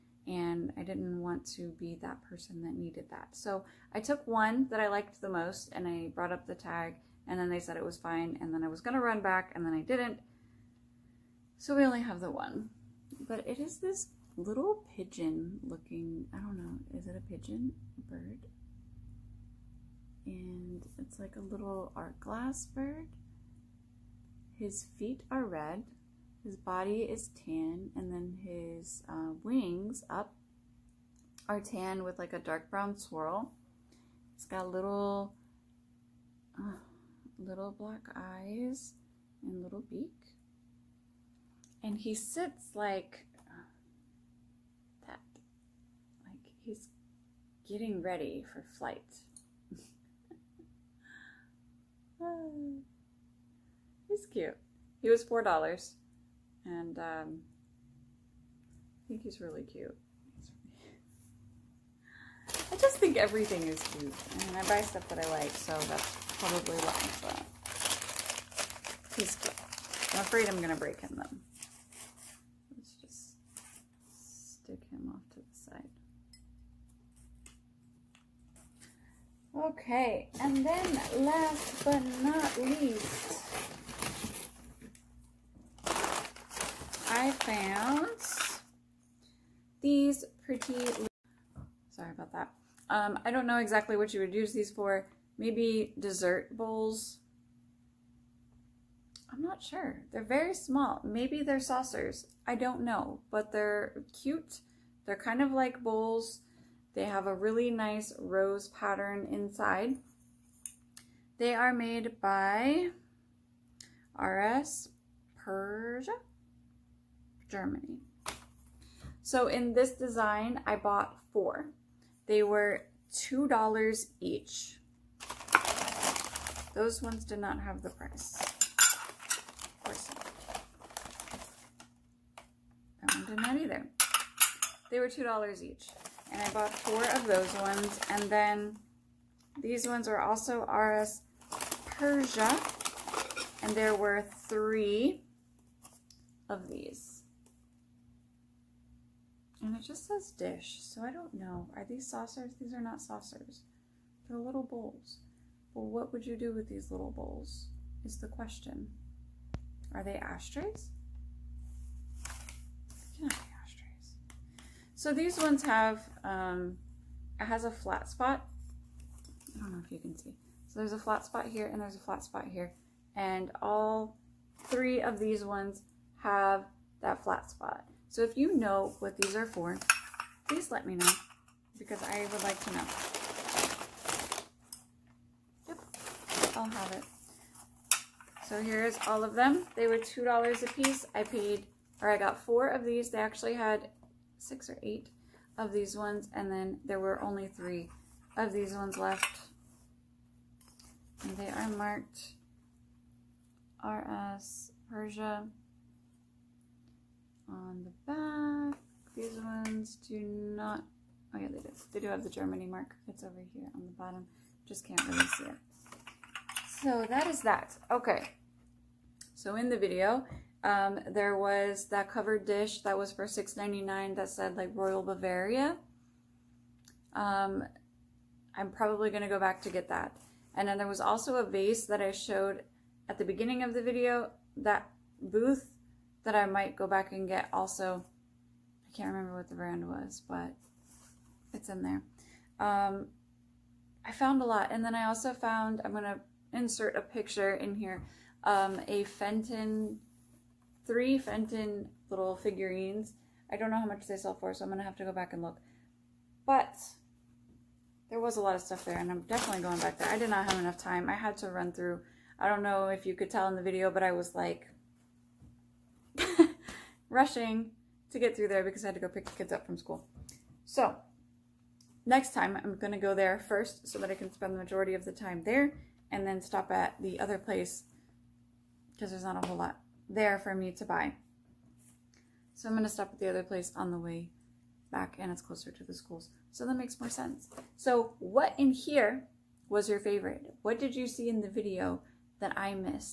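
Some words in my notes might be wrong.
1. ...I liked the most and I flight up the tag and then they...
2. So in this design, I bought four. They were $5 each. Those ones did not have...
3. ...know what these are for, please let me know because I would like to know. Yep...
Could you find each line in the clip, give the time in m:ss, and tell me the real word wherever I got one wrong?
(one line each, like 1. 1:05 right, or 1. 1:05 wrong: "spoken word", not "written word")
1. 0:04 wrong: "brought", not "flight"
2. 1:59 wrong: "2", not "5"
3. 2:58 right.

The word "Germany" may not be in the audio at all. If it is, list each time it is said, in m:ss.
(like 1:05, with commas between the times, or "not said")
1:57, 3:32.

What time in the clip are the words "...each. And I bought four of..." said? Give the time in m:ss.
2:15.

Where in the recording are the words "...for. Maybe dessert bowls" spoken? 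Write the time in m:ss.
1:34.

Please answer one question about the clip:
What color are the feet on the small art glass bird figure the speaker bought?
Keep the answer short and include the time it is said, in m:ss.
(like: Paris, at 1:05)
Red, at 0:25.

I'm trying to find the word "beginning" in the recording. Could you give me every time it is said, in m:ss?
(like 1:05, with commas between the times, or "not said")
3:53.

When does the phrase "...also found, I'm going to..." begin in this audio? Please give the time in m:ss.
4:05.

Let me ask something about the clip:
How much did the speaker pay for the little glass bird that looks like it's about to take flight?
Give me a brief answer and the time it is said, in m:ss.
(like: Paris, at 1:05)
$4, at 0:55.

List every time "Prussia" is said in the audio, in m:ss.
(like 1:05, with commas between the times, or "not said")
1:55, 2:21, 3:24.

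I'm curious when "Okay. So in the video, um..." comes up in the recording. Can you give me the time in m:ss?
3:37.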